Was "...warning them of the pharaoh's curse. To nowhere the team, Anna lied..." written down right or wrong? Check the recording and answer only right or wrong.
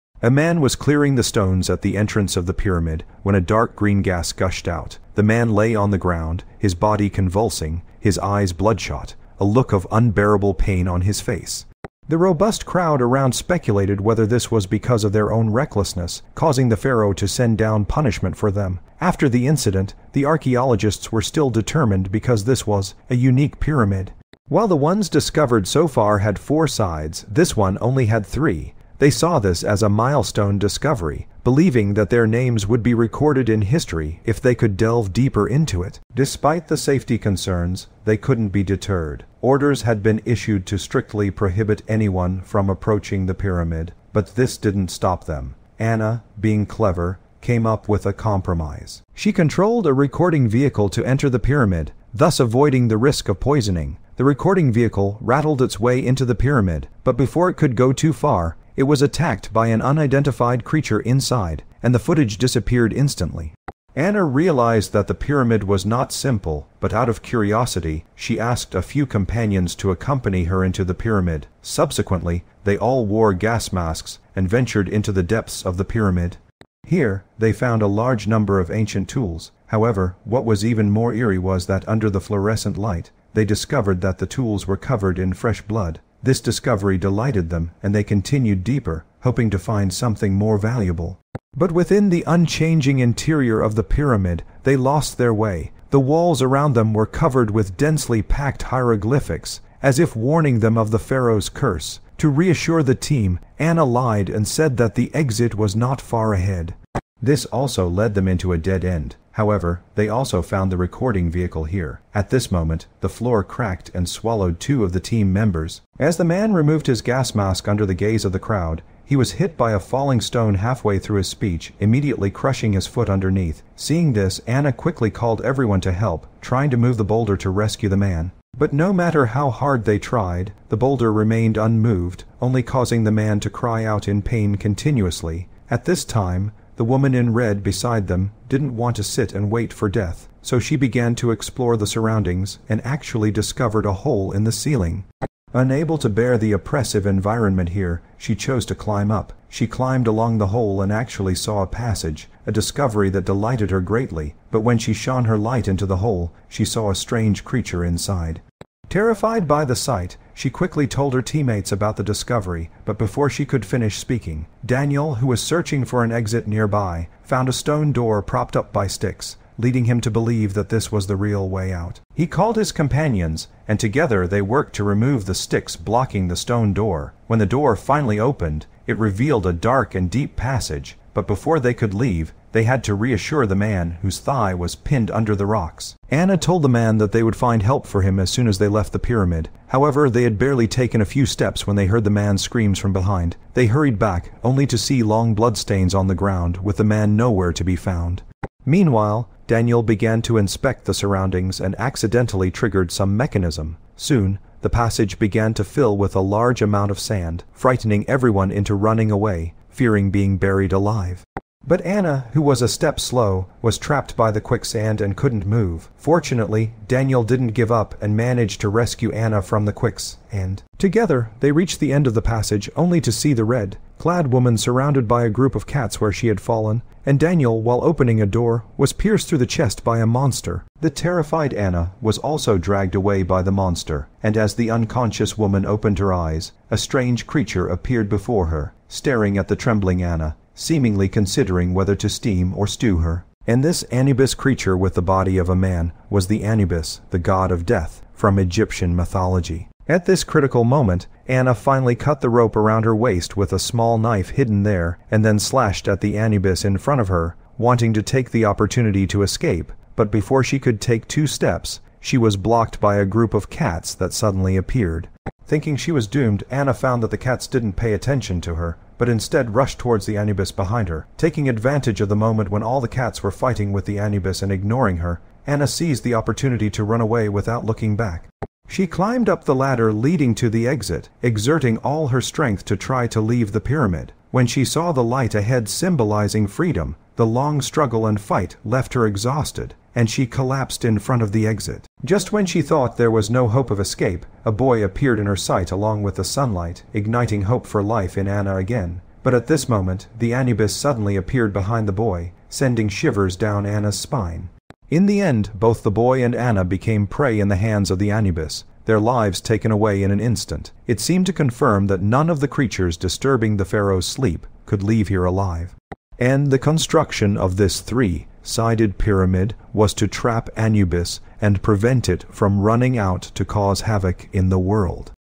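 wrong.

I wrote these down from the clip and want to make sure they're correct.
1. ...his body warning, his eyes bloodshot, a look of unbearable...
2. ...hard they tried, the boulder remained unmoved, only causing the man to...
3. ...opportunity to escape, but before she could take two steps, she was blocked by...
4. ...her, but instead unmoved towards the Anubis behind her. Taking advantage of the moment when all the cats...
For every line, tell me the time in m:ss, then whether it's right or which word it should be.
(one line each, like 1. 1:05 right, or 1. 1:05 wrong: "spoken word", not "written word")
1. 0:06 wrong: "convulsing", not "warning"
2. 2:09 right
3. 4:18 right
4. 4:28 wrong: "rushed", not "unmoved".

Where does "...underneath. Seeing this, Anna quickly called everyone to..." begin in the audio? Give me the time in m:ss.
2:03.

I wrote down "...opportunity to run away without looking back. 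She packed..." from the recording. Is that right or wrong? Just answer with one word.
wrong.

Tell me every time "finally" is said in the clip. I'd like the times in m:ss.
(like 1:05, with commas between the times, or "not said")
2:57, 4:11.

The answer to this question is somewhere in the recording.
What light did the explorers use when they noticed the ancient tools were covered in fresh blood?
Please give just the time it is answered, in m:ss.
1:22.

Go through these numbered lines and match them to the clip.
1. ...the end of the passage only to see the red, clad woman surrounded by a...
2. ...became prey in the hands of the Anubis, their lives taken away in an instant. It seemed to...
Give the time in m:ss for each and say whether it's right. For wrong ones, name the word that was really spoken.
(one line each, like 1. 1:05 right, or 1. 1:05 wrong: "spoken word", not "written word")
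1. 3:41 right
2. 5:06 right.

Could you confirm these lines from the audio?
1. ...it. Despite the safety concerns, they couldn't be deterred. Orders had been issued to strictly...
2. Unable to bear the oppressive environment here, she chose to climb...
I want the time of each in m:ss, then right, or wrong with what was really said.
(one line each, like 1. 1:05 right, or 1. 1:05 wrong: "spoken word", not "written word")
1. 0:35 right
2. 2:25 right.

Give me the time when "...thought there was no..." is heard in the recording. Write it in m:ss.
4:52.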